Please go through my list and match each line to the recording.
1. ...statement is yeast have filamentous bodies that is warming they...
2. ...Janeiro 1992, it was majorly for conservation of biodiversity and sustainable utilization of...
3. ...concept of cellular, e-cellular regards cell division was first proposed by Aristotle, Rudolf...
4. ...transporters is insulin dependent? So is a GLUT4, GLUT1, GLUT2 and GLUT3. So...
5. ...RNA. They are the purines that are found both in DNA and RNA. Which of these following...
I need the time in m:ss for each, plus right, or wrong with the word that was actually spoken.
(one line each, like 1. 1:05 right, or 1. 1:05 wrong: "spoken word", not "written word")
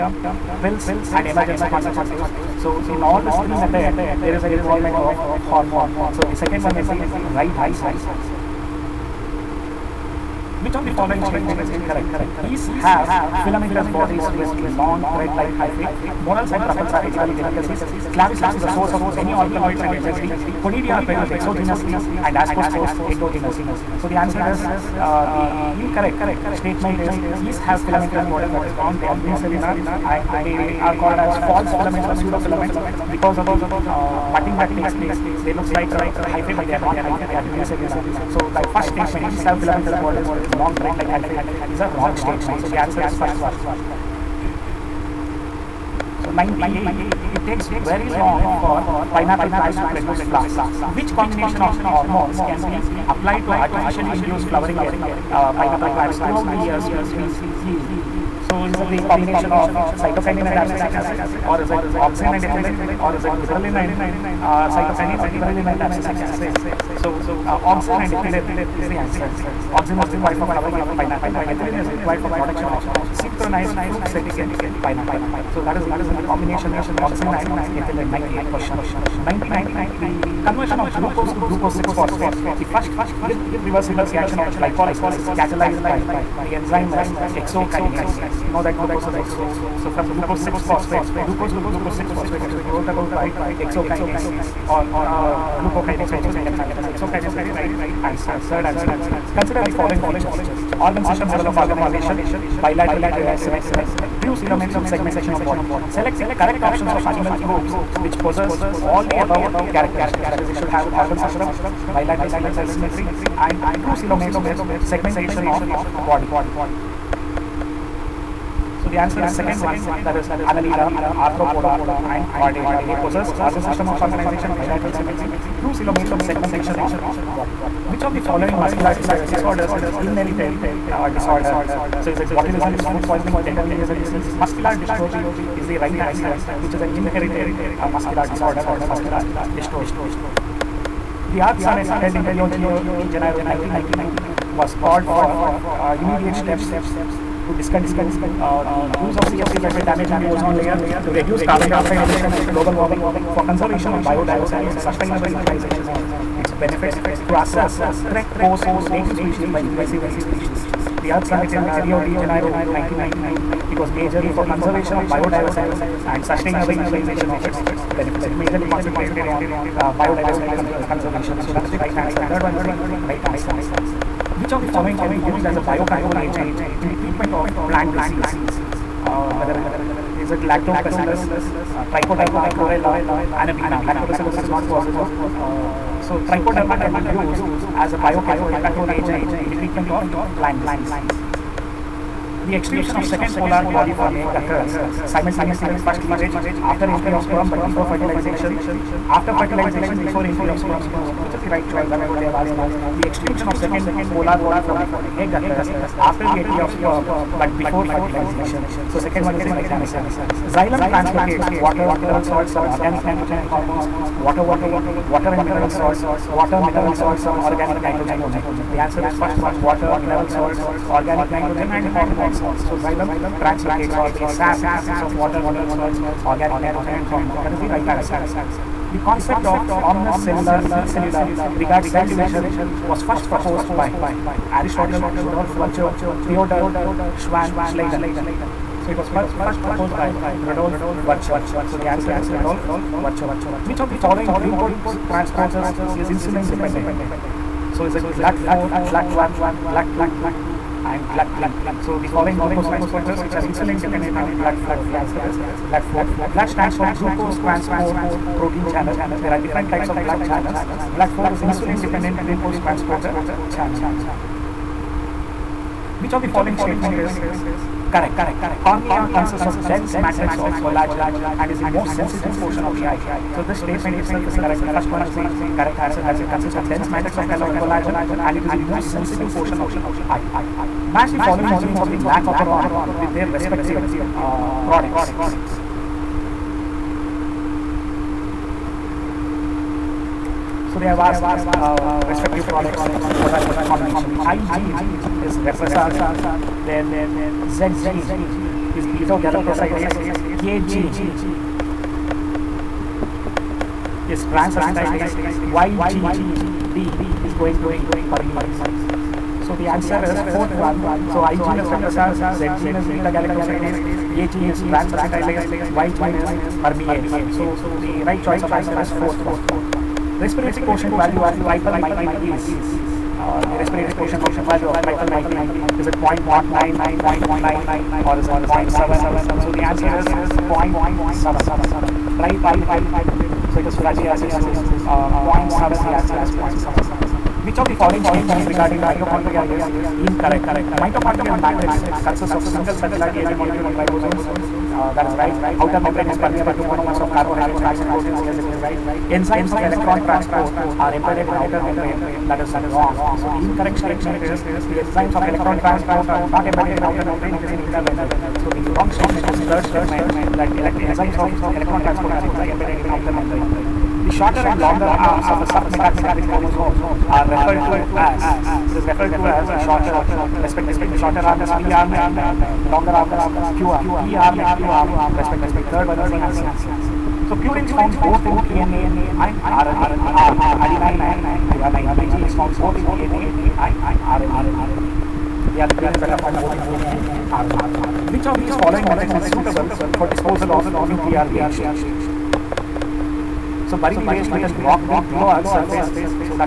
1. 0:26 wrong: "wrong", not "warming"
2. 2:42 right
3. 3:49 right
4. 4:05 right
5. 6:24 right.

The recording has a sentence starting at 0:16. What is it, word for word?
Morels and truffles are edible delicacies.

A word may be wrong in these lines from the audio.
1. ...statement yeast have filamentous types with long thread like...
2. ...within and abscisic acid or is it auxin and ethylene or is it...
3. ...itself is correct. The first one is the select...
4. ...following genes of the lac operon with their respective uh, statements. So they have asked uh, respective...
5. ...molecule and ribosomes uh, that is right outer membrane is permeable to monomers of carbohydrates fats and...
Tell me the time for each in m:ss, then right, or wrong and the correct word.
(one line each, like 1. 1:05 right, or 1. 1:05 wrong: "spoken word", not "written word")
1. 0:38 wrong: "bodies", not "types"
2. 1:00 wrong: "cytokinin", not "within"
3. 4:33 wrong: "correct", not "select"
4. 4:41 wrong: "products", not "statements"
5. 5:43 right.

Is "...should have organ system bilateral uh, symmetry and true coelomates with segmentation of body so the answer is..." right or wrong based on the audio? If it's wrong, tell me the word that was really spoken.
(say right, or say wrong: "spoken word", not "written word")
right.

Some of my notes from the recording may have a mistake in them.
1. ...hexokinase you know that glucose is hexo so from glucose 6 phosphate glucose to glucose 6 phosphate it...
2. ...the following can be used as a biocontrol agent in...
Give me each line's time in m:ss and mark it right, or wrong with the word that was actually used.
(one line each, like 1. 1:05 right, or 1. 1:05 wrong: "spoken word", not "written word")
1. 1:27 right
2. 2:54 right.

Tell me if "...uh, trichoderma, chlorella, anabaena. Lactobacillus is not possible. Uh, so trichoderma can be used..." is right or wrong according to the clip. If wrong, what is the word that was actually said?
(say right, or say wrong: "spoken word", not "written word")
right.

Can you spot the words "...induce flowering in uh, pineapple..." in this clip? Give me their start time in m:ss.
0:54.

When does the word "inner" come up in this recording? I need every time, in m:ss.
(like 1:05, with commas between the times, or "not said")
5:57.